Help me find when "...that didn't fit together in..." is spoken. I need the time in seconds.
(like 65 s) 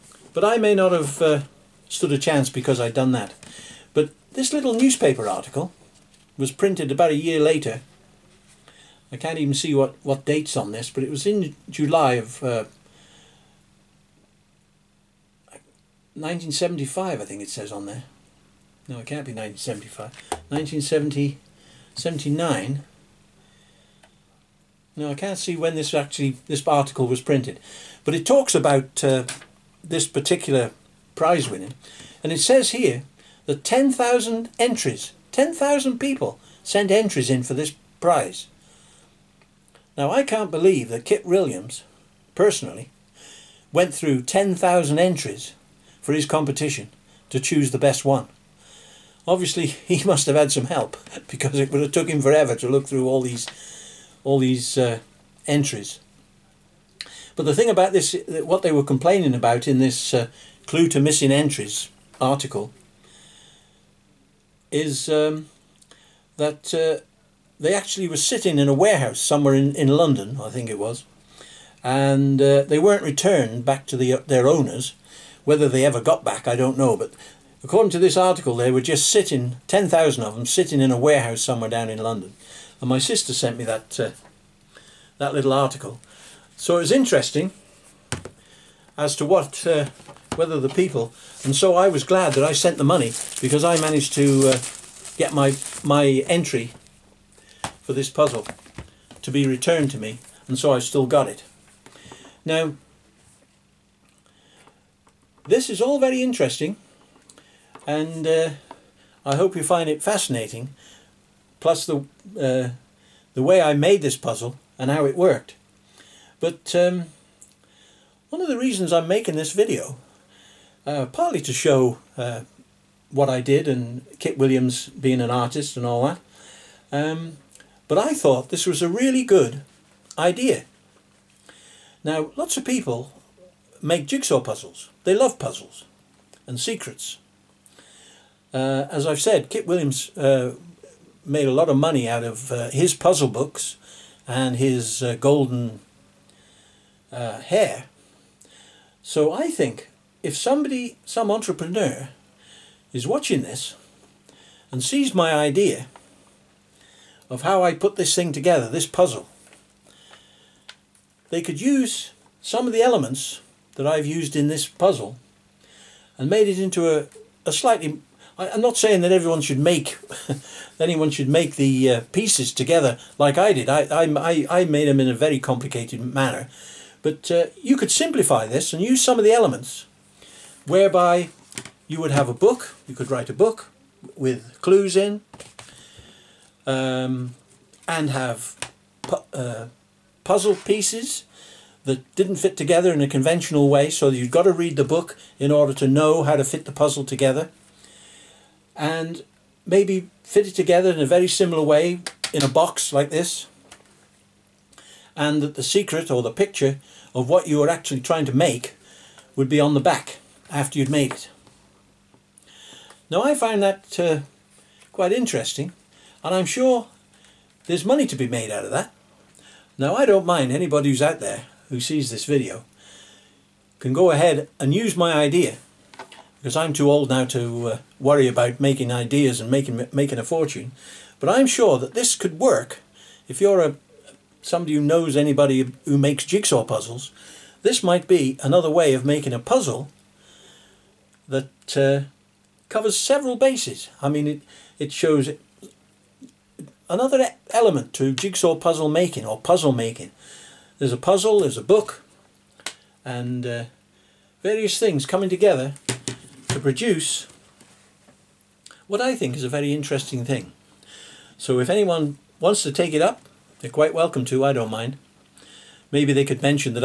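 191 s.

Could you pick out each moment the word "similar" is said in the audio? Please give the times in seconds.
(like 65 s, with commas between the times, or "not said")
201 s.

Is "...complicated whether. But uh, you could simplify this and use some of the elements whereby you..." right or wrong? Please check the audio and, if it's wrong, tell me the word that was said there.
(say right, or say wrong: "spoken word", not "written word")
wrong: "manner", not "whether".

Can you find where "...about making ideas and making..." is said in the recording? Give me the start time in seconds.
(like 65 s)
228 s.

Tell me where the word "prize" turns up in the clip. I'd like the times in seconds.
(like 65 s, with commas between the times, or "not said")
31 s, 37 s.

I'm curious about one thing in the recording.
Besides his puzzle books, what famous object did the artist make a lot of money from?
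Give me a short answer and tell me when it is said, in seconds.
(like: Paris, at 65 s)
golden hare, at 145 s.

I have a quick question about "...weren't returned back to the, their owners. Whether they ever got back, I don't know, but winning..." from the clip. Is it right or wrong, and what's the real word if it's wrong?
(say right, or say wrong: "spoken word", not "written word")
wrong: "according", not "winning".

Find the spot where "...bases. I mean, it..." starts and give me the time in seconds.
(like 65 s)
243 s.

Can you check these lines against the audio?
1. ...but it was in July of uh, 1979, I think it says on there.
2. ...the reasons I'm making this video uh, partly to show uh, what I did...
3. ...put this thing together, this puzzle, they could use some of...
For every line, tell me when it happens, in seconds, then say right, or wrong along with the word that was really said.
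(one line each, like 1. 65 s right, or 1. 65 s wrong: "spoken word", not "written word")
1. 10 s wrong: "1975", not "1979"
2. 118 s right
3. 157 s right.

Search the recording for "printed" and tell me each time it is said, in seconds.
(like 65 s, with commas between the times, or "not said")
6 s, 27 s.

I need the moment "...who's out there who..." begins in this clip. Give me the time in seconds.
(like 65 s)
220 s.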